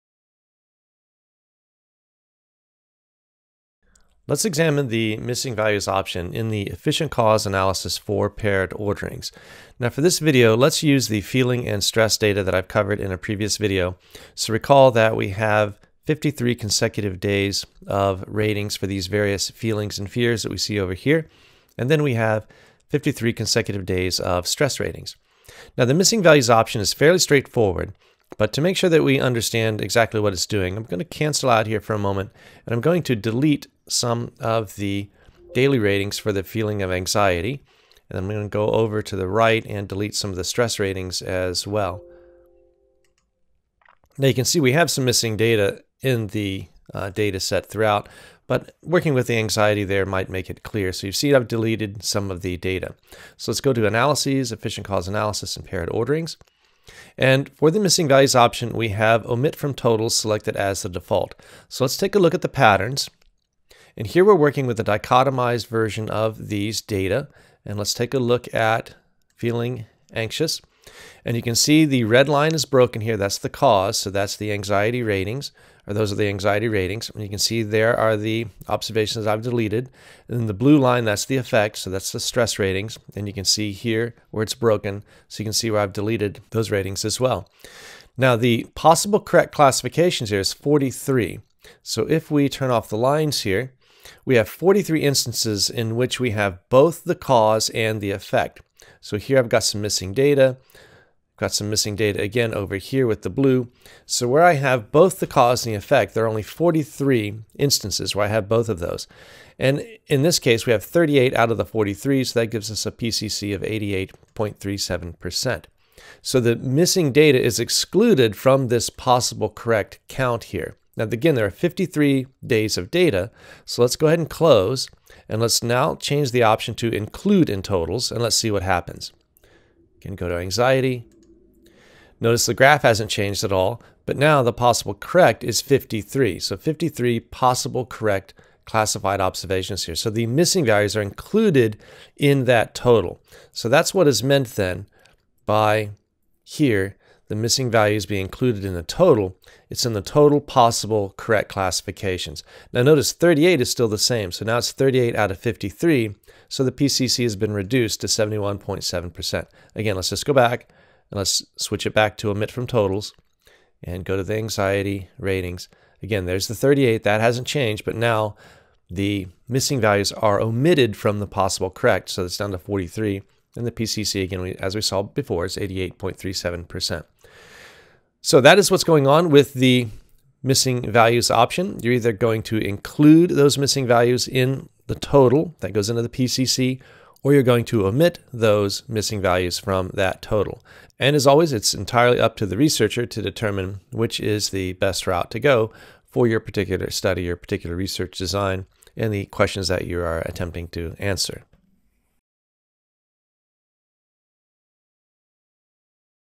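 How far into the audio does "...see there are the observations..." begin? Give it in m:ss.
1:17.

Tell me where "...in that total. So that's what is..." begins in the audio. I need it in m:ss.
2:22.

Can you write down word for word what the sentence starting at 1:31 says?
So if we turn off the lines here, we have 43 instances in which we have both the cause and the effect.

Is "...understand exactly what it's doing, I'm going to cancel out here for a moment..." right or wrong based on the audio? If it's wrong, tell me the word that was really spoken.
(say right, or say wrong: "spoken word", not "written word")
right.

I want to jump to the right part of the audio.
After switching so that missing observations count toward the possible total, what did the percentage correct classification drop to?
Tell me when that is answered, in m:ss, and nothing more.
2:38.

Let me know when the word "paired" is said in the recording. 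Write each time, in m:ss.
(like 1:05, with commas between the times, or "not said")
0:08, 0:55.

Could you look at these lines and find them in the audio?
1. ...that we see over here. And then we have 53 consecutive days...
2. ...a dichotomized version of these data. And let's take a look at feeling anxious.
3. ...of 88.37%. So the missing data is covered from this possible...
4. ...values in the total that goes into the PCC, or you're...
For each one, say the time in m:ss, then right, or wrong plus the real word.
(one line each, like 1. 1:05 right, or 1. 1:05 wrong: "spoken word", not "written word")
1. 0:20 right
2. 1:04 right
3. 1:53 wrong: "excluded", not "covered"
4. 3:03 right.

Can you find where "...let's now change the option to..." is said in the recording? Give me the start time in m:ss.
2:05.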